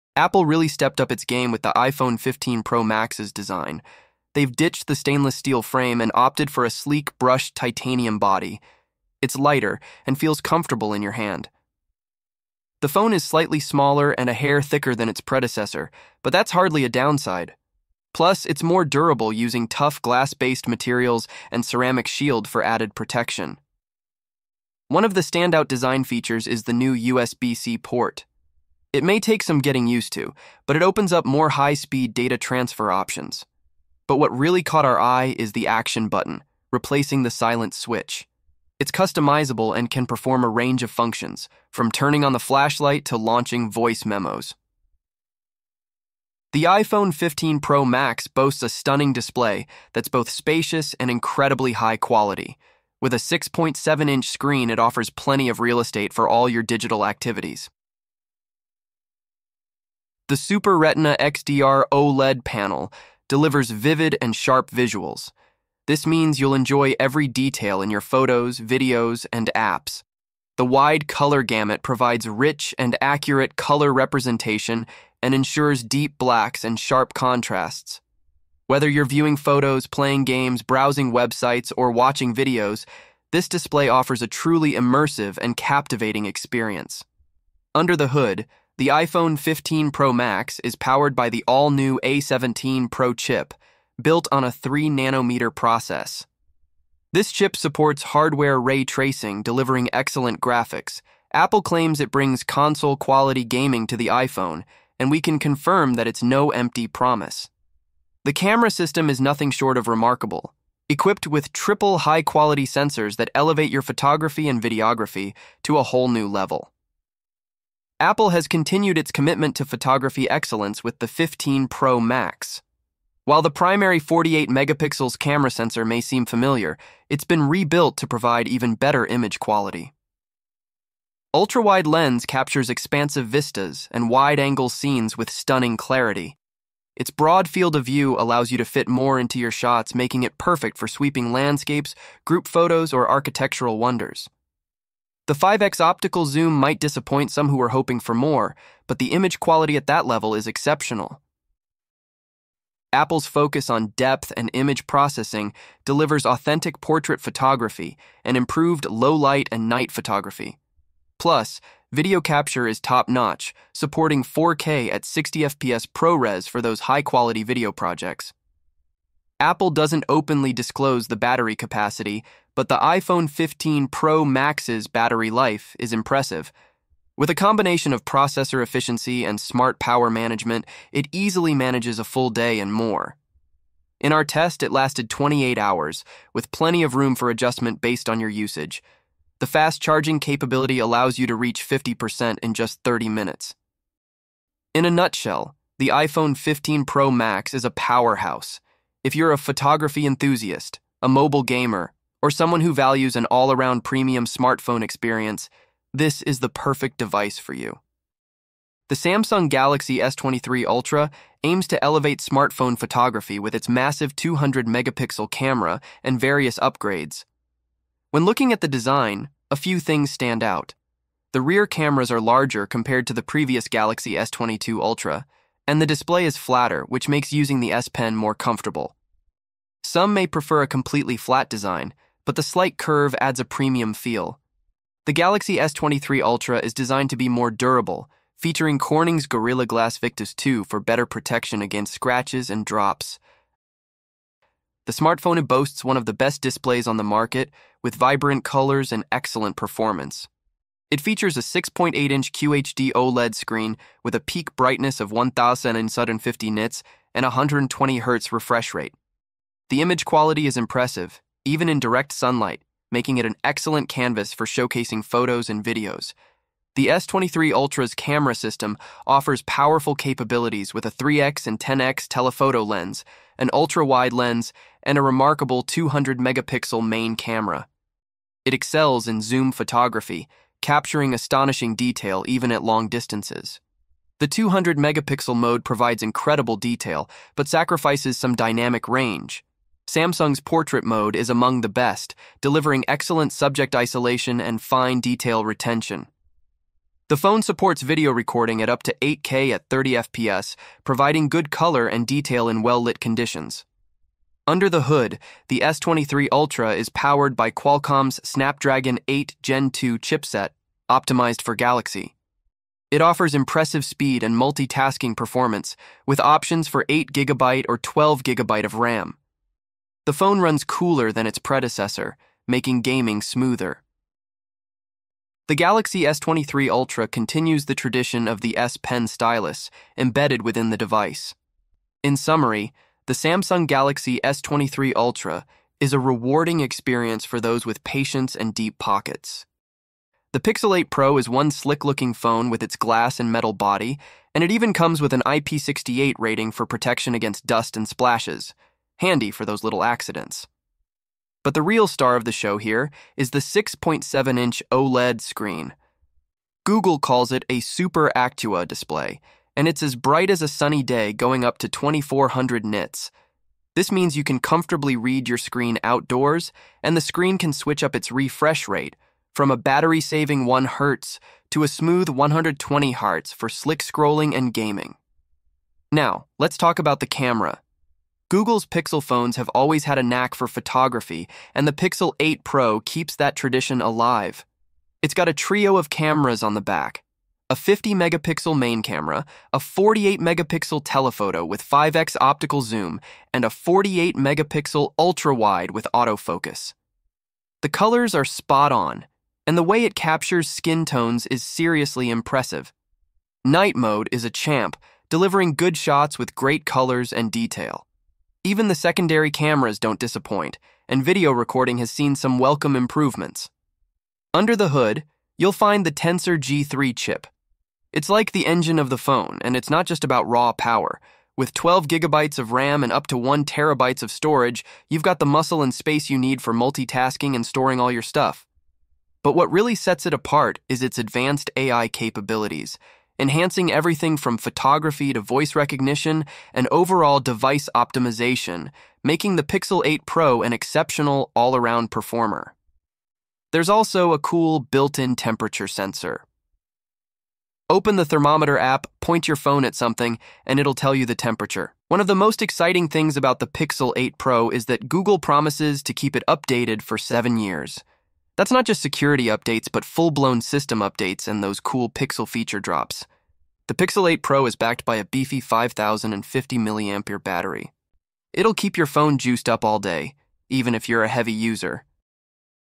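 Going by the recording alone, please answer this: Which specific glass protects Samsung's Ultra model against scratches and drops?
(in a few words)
Gorilla Glass Victus 2.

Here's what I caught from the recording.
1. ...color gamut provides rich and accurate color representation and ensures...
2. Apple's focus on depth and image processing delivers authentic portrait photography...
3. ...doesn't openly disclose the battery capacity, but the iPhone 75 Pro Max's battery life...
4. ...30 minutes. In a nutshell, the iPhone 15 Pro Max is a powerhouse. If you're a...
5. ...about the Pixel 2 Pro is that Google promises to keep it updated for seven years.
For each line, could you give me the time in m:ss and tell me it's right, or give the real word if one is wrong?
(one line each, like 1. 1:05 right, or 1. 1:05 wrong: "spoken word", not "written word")
1. 1:11 right
2. 2:32 right
3. 2:49 wrong: "15", not "75"
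4. 3:12 right
5. 7:33 wrong: "8", not "2".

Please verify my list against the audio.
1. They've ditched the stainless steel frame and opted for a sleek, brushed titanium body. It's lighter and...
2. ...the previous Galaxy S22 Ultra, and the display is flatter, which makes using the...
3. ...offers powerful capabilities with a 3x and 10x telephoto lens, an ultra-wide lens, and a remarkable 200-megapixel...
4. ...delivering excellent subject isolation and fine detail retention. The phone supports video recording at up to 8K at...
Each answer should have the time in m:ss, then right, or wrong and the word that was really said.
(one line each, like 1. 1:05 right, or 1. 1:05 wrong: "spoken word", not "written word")
1. 0:04 right
2. 3:43 right
3. 4:29 right
4. 4:52 right.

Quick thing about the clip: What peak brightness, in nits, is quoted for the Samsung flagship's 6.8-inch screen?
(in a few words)
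1050 nits.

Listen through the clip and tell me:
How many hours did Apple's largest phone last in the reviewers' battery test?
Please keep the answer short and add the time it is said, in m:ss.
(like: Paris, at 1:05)
28 hours, at 3:05.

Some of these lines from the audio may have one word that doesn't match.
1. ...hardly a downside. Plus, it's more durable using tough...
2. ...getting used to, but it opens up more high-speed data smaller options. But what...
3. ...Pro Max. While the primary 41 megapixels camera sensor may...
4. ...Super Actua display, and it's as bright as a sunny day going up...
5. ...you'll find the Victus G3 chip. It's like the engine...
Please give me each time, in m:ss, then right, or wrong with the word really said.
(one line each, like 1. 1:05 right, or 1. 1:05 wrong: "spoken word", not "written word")
1. 0:16 right
2. 0:29 wrong: "transfer", not "smaller"
3. 2:01 wrong: "48", not "41"
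4. 5:57 right
5. 6:55 wrong: "Tensor", not "Victus".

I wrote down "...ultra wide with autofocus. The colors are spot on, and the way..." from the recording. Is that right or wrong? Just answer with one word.
right.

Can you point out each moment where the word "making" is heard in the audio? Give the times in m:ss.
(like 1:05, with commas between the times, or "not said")
2:19, 4:22, 5:22, 7:19.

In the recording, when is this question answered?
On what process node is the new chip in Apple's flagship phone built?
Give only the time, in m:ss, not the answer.
1:34.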